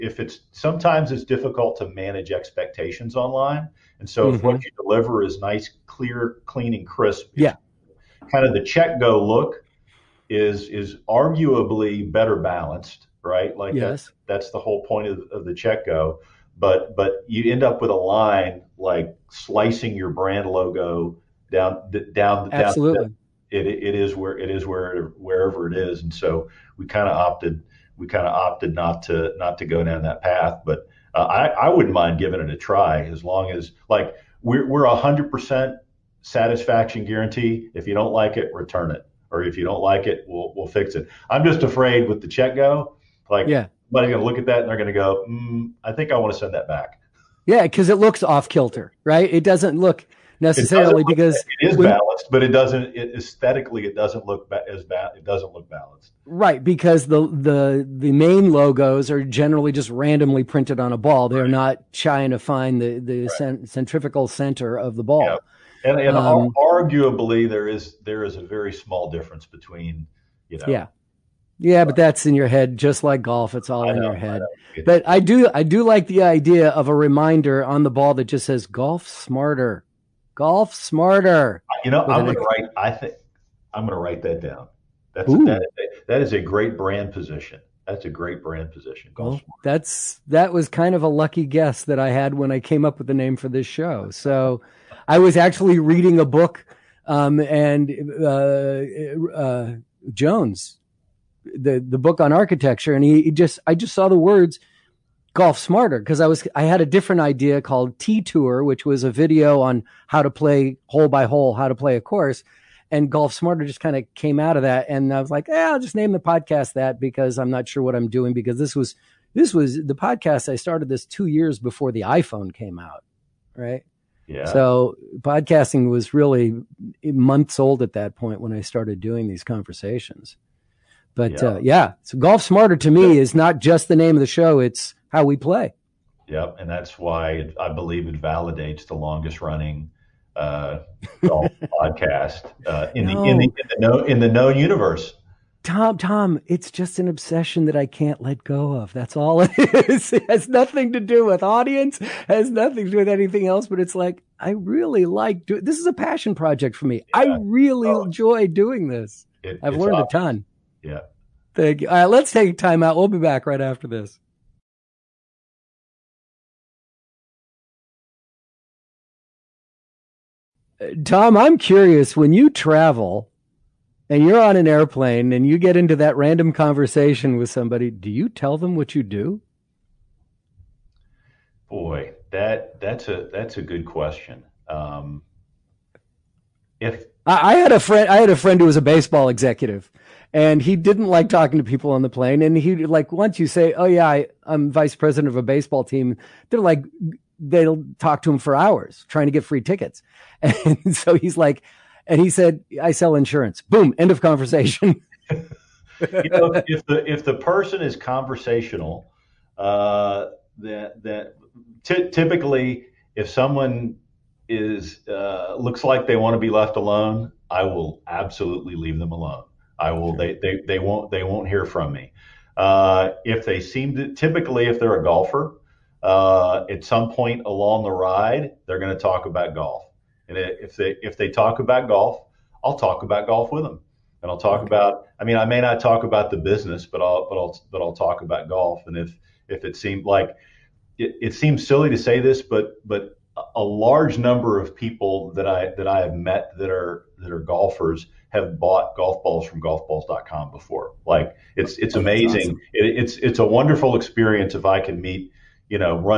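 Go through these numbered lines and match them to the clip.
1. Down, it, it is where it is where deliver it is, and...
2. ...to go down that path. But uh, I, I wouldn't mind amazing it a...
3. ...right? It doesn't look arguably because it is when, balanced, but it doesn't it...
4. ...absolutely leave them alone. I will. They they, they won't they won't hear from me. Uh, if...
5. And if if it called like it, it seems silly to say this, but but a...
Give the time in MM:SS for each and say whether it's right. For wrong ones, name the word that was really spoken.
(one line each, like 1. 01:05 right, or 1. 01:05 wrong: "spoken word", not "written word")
1. 00:23 wrong: "wherever", not "deliver"
2. 00:29 wrong: "giving", not "amazing"
3. 00:49 wrong: "necessarily", not "arguably"
4. 03:38 right
5. 03:58 wrong: "seemed", not "called".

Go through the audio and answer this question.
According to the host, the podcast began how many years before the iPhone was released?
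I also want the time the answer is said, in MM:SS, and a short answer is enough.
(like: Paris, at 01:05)
2, at 02:01.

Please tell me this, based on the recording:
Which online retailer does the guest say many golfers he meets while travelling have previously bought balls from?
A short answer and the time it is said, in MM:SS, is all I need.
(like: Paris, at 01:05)
golfballs.com, at 04:09.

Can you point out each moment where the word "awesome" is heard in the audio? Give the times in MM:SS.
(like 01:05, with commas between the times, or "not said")
02:39, 04:12.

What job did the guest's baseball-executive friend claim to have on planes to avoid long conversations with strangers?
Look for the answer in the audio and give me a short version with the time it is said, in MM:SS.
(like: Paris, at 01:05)
insurance, at 03:22.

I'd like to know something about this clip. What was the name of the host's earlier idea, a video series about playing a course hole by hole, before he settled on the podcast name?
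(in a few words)
T Tour.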